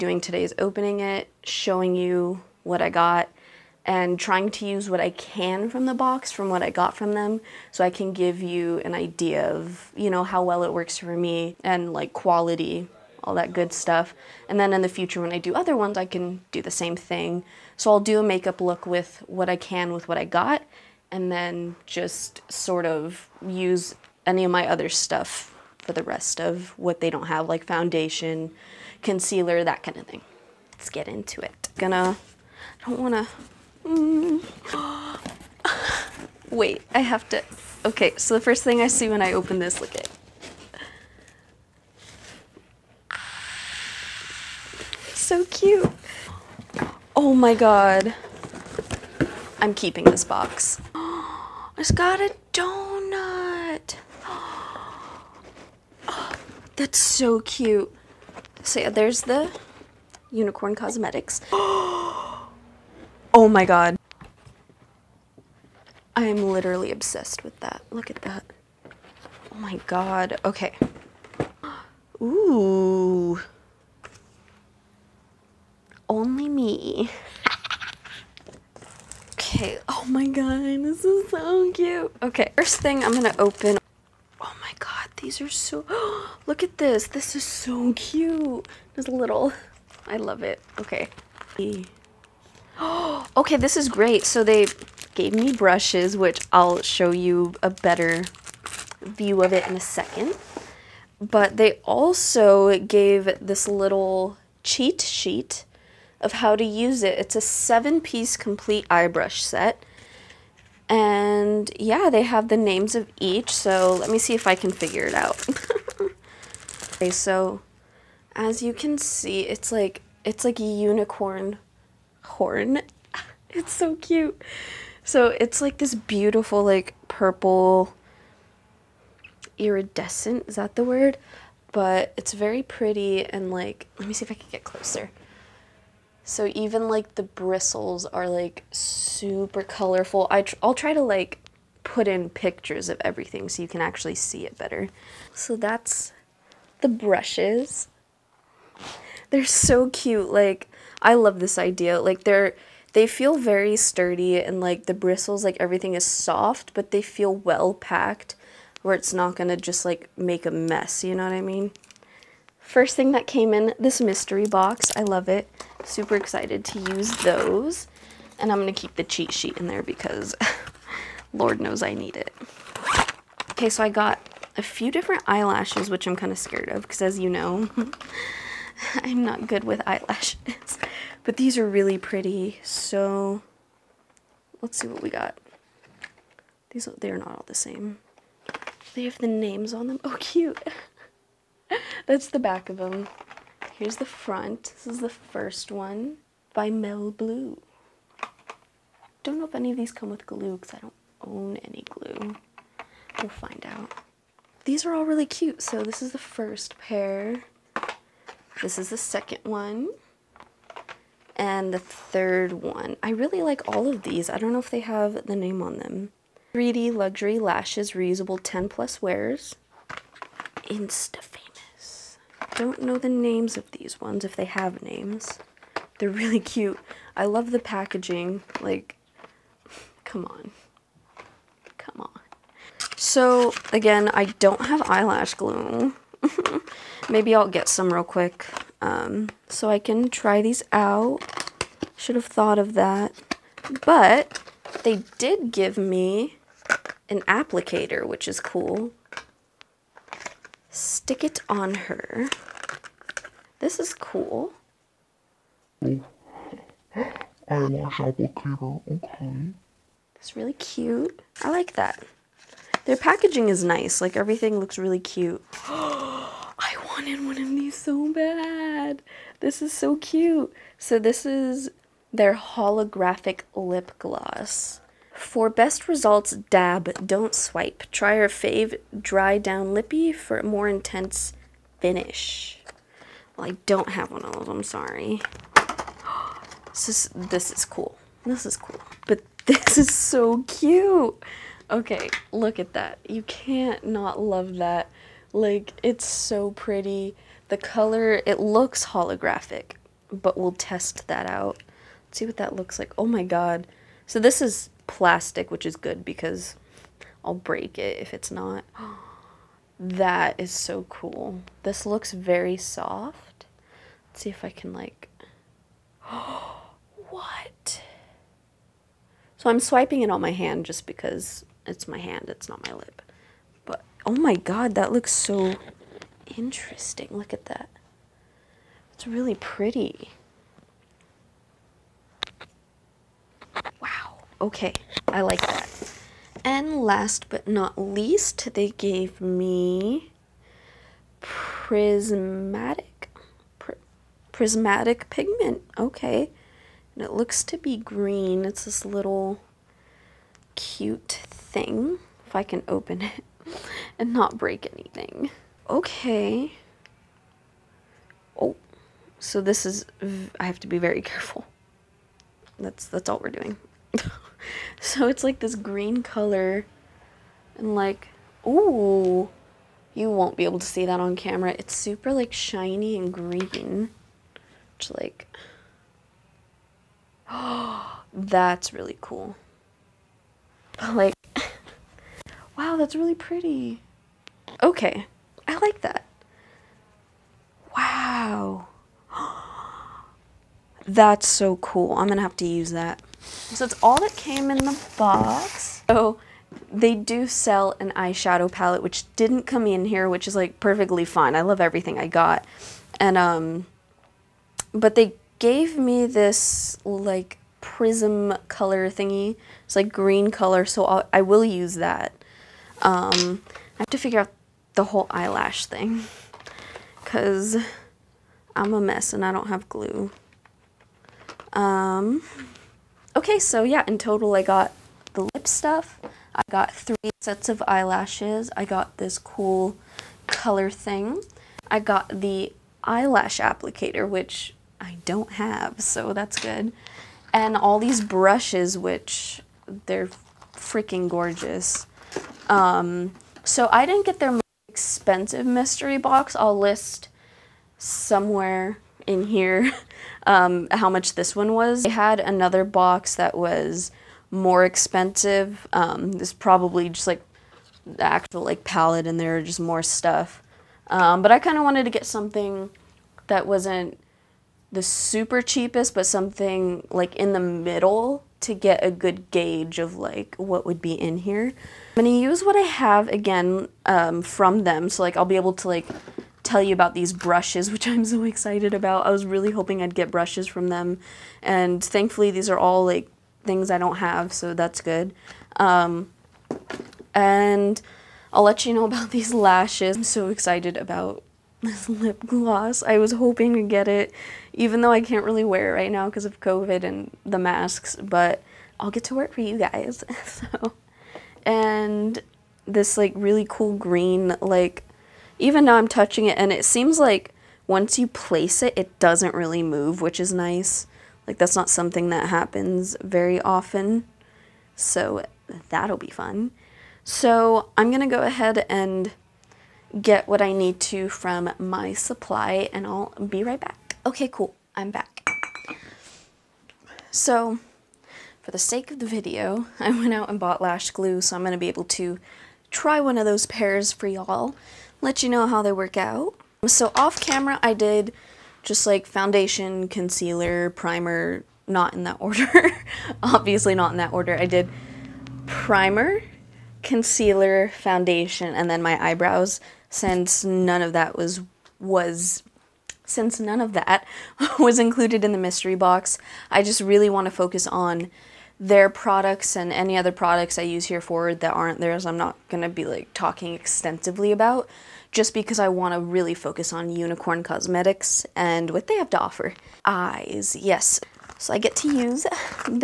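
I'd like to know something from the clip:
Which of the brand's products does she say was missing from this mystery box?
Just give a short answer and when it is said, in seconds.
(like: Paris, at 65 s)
Eyeshadow palette, at 397 s.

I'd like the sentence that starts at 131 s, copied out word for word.
But it's very pretty and like, let me see if I can get closer.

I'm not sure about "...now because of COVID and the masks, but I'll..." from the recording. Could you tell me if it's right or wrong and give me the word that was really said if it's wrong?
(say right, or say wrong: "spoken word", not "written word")
right.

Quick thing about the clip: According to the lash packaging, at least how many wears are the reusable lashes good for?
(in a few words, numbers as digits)
10.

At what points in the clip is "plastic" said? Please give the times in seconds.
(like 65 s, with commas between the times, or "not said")
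304 s.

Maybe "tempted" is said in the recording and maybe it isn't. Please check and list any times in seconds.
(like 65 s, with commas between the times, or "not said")
not said.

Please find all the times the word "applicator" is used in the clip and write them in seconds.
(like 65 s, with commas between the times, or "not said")
247 s, 257 s, 433 s.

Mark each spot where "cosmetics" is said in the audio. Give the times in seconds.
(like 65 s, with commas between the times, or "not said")
60 s, 567 s.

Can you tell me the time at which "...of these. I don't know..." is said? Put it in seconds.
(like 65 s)
213 s.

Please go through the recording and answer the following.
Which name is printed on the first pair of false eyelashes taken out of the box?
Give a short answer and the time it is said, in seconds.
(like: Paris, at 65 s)
Mel Blue, at 196 s.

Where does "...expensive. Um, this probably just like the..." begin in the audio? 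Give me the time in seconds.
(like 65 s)
454 s.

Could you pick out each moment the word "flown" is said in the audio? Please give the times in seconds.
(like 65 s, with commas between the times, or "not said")
not said.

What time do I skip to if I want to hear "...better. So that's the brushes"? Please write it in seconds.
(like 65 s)
144 s.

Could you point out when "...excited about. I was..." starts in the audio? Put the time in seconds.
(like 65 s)
478 s.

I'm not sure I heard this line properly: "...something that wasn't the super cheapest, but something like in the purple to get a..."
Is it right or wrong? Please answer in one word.
wrong.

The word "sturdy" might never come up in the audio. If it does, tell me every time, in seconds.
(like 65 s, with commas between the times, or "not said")
153 s.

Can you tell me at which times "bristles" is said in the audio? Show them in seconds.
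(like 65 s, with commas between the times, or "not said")
137 s, 154 s.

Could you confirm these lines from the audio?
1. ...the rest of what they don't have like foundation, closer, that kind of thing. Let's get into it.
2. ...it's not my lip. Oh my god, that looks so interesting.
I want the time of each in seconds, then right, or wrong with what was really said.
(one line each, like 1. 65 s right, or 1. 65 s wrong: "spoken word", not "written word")
1. 25 s wrong: "concealer", not "closer"
2. 322 s right.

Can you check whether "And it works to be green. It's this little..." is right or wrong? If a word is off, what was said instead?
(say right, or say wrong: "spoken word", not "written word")
wrong: "looks", not "works".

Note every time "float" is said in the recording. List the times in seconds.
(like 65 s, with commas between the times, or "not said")
not said.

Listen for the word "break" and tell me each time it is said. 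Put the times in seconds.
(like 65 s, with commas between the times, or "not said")
307 s, 354 s.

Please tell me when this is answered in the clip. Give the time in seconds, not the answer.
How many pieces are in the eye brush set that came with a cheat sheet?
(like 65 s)
107 s.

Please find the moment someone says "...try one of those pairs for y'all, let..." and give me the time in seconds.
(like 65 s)
532 s.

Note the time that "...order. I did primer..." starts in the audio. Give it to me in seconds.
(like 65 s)
544 s.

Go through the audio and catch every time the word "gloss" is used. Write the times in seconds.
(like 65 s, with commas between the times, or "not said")
273 s, 492 s.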